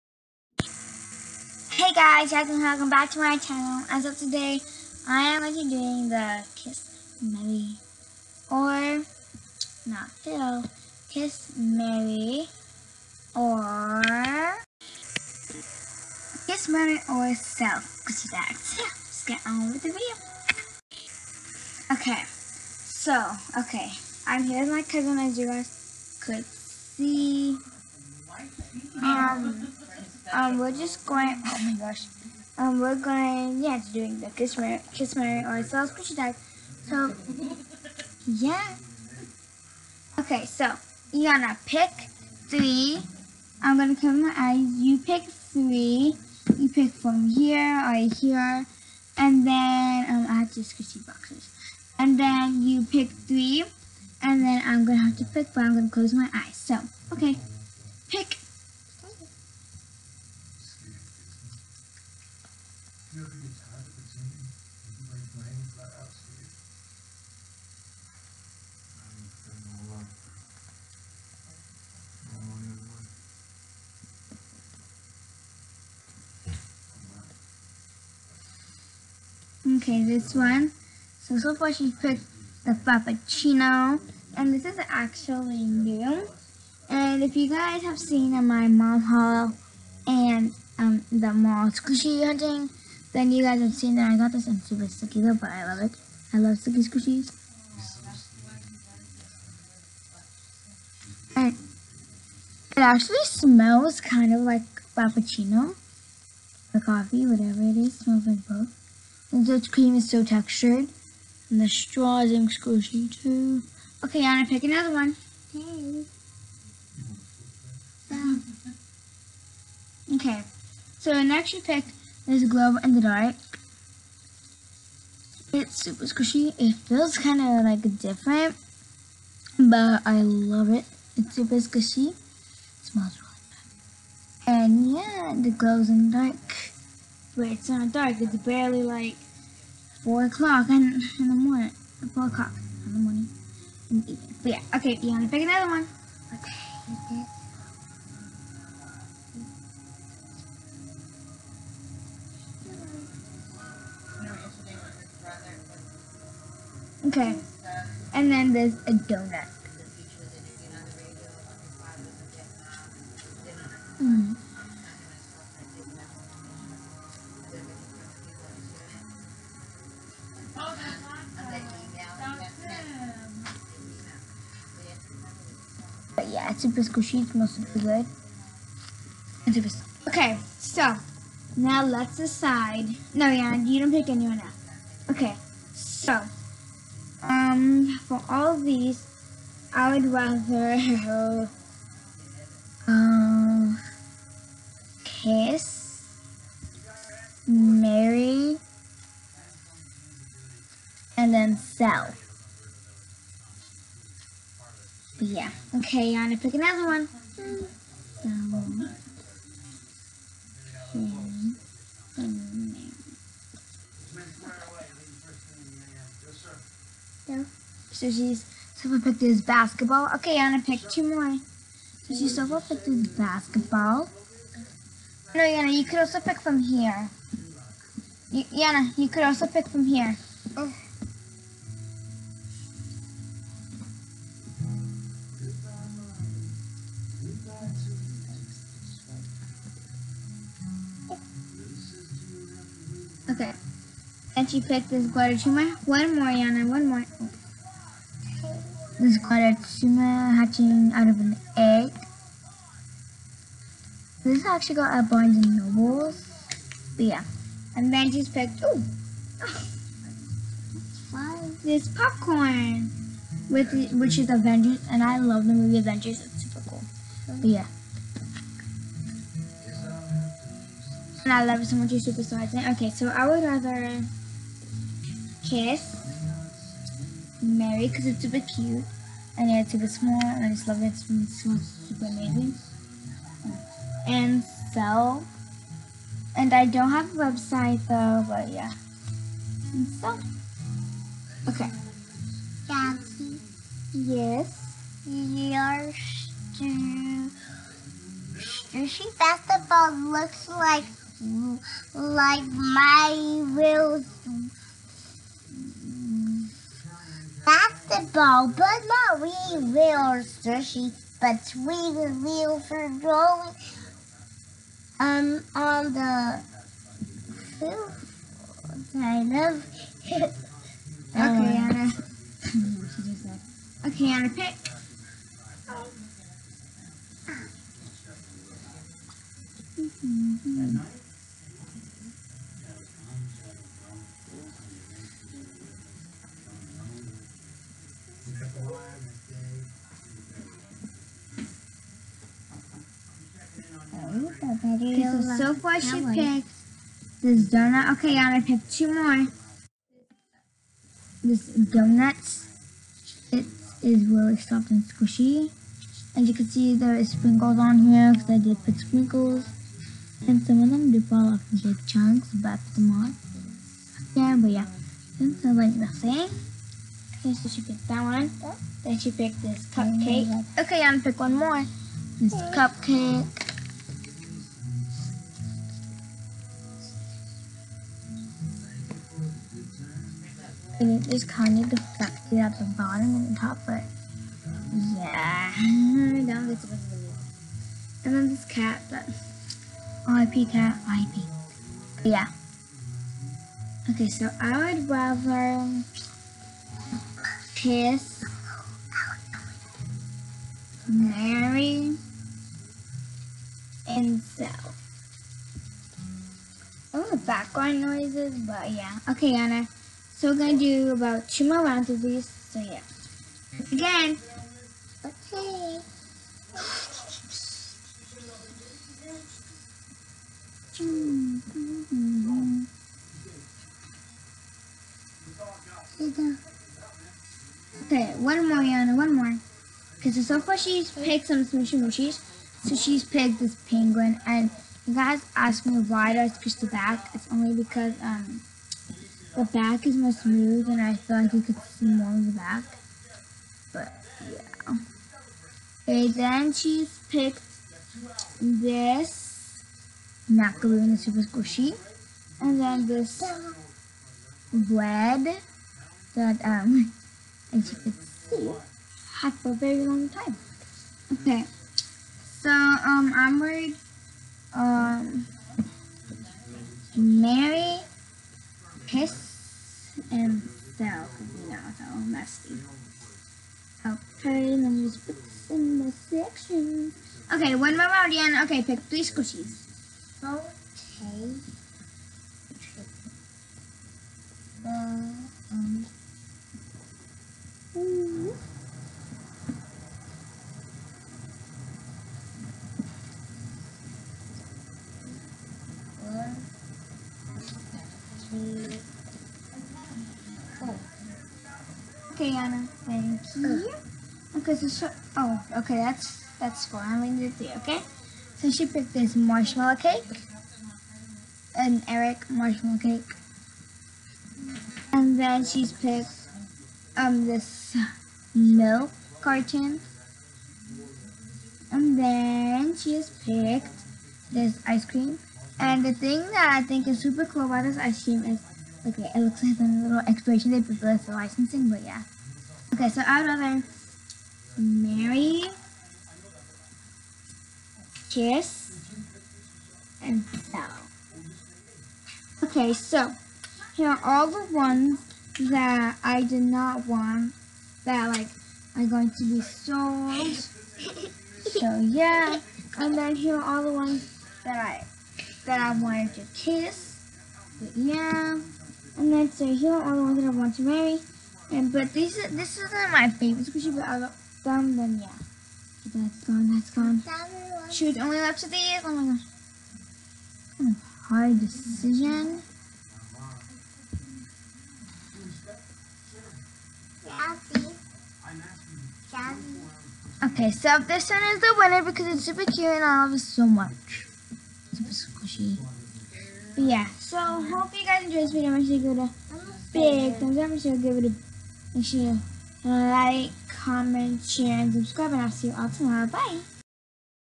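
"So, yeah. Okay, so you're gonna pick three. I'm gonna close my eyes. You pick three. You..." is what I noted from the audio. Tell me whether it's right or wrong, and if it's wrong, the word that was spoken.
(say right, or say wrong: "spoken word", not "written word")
right.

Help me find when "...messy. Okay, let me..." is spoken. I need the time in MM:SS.
07:51.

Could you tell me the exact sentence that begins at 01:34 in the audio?
and super sticky though, but I love it.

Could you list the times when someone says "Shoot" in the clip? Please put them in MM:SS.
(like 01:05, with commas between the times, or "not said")
09:27.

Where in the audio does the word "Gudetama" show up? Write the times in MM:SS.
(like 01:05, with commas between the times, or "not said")
04:05, 04:09.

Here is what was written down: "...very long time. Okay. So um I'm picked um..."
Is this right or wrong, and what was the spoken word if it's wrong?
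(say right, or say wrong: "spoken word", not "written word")
wrong: "worried", not "picked".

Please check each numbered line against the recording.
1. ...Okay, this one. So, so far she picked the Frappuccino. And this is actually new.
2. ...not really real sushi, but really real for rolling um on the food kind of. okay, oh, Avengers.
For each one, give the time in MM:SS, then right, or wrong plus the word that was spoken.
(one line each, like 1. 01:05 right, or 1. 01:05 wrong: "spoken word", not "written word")
1. 01:19 right
2. 05:08 wrong: "Anna", not "Avengers".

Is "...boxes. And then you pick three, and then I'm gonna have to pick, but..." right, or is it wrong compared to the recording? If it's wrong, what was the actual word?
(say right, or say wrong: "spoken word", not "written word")
right.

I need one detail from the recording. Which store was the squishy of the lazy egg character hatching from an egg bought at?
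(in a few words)
Barnes and Nobles.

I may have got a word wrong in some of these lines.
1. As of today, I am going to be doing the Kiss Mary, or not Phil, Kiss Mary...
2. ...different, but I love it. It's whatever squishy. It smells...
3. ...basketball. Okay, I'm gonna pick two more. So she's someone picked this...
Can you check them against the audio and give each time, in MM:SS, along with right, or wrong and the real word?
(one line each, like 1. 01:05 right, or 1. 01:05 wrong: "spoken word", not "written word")
1. 00:03 right
2. 02:07 wrong: "super", not "whatever"
3. 03:39 right.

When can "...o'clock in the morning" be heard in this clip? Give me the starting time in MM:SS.
02:22.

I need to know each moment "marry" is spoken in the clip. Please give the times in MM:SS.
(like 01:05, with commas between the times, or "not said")
03:17, 09:20.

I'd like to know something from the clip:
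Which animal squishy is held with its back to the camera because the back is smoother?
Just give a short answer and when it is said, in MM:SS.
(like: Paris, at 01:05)
Penguin, at 07:13.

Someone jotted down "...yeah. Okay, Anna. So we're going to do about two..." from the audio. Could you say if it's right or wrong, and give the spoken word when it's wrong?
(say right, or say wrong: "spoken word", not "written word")
right.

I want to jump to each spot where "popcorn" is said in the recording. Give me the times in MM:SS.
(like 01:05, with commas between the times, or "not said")
04:21.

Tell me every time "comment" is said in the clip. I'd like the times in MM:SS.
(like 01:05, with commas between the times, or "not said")
09:53.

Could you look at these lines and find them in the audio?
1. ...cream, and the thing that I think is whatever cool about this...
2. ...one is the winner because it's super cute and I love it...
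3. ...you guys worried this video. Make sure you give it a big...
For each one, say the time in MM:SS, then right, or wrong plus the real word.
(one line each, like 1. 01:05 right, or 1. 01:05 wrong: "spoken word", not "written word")
1. 08:44 wrong: "super", not "whatever"
2. 09:41 right
3. 09:47 wrong: "enjoyed", not "worried".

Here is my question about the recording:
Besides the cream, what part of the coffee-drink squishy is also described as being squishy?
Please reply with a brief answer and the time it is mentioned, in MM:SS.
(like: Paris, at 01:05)
The straw, at 01:51.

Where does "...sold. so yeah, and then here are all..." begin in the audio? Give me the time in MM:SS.
09:09.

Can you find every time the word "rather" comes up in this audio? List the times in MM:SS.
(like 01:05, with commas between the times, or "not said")
03:10, 04:33, 06:34, 08:53.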